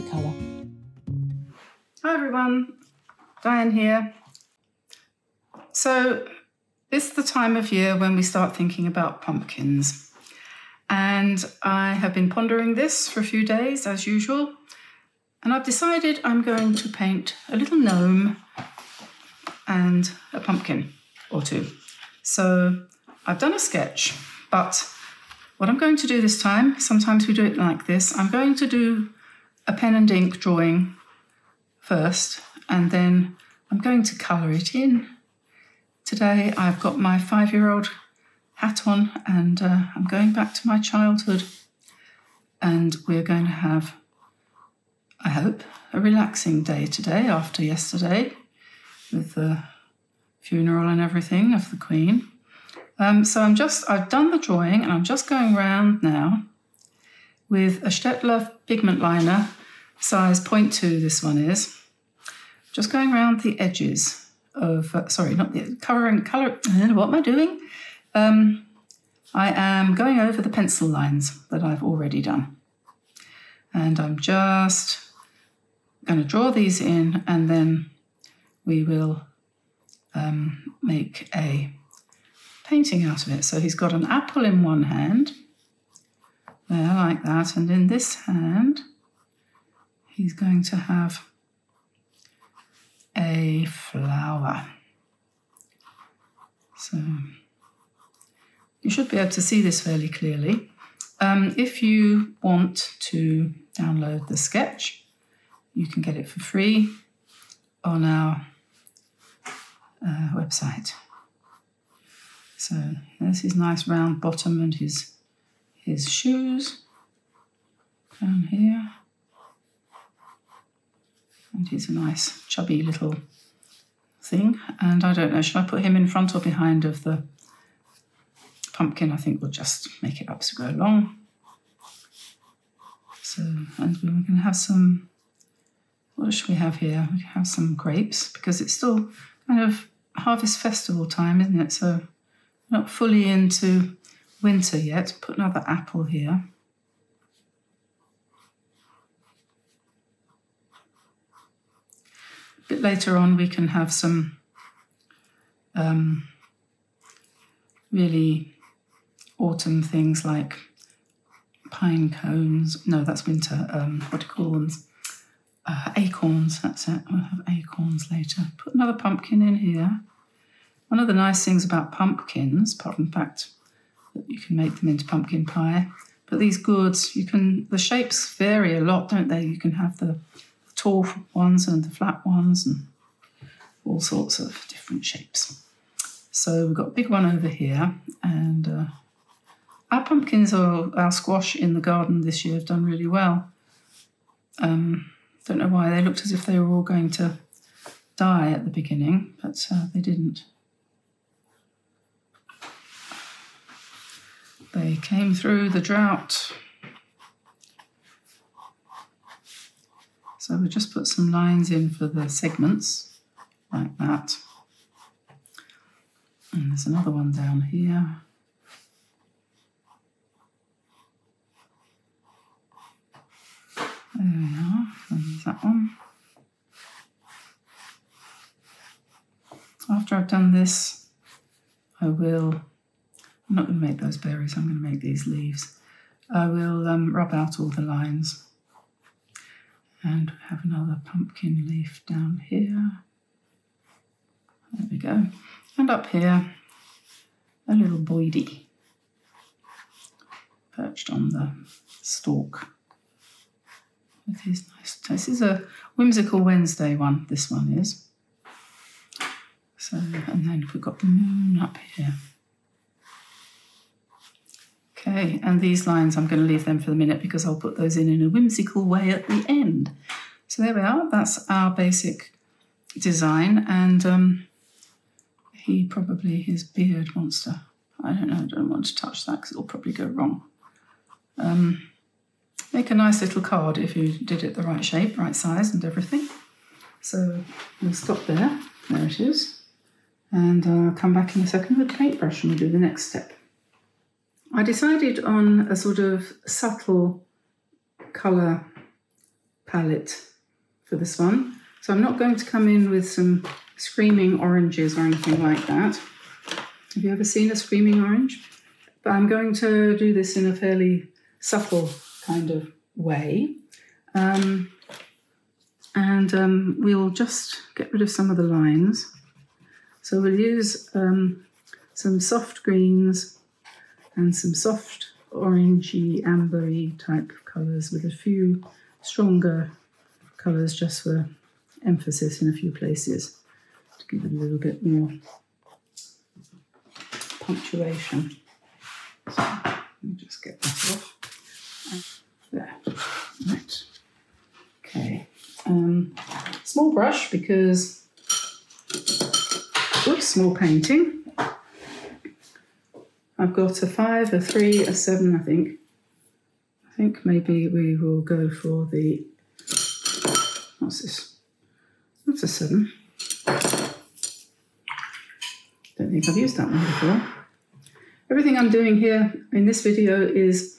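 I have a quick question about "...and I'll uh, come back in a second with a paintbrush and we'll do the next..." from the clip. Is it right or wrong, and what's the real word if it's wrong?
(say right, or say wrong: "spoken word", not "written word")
right.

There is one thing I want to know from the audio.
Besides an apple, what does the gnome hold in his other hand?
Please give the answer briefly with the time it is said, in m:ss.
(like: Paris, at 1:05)
a flower, at 1:33.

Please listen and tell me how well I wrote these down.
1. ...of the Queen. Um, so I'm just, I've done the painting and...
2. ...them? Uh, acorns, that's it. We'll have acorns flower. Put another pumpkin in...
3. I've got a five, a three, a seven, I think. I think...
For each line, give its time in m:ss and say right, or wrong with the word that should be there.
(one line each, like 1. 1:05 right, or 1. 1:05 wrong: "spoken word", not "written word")
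1. 0:51 wrong: "drawing", not "painting"
2. 2:44 wrong: "later", not "flower"
3. 5:53 right.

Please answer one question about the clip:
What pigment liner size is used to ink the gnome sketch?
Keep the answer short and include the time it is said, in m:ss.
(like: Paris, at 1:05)
0.2, at 1:00.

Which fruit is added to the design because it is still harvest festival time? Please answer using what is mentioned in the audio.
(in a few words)
grapes.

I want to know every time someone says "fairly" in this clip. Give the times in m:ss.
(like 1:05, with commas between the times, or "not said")
1:39, 5:10.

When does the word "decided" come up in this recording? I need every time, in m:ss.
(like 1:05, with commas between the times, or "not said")
0:15, 4:54.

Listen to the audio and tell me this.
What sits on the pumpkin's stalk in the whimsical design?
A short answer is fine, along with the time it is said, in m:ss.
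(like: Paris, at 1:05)
a little boydie, at 4:07.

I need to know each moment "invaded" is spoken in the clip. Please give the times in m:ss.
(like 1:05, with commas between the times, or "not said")
not said.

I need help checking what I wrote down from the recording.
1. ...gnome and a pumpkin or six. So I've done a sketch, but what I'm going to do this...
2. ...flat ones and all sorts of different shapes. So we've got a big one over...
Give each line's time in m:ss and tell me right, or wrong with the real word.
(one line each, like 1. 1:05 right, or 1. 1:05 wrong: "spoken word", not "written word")
1. 0:17 wrong: "two", not "six"
2. 3:01 right.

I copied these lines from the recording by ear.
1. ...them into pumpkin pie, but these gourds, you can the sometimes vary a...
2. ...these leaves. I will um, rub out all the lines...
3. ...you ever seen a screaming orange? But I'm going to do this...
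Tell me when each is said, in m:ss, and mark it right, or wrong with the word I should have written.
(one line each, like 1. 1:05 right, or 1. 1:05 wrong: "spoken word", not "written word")
1. 2:54 wrong: "shapes", not "sometimes"
2. 3:54 right
3. 5:07 right.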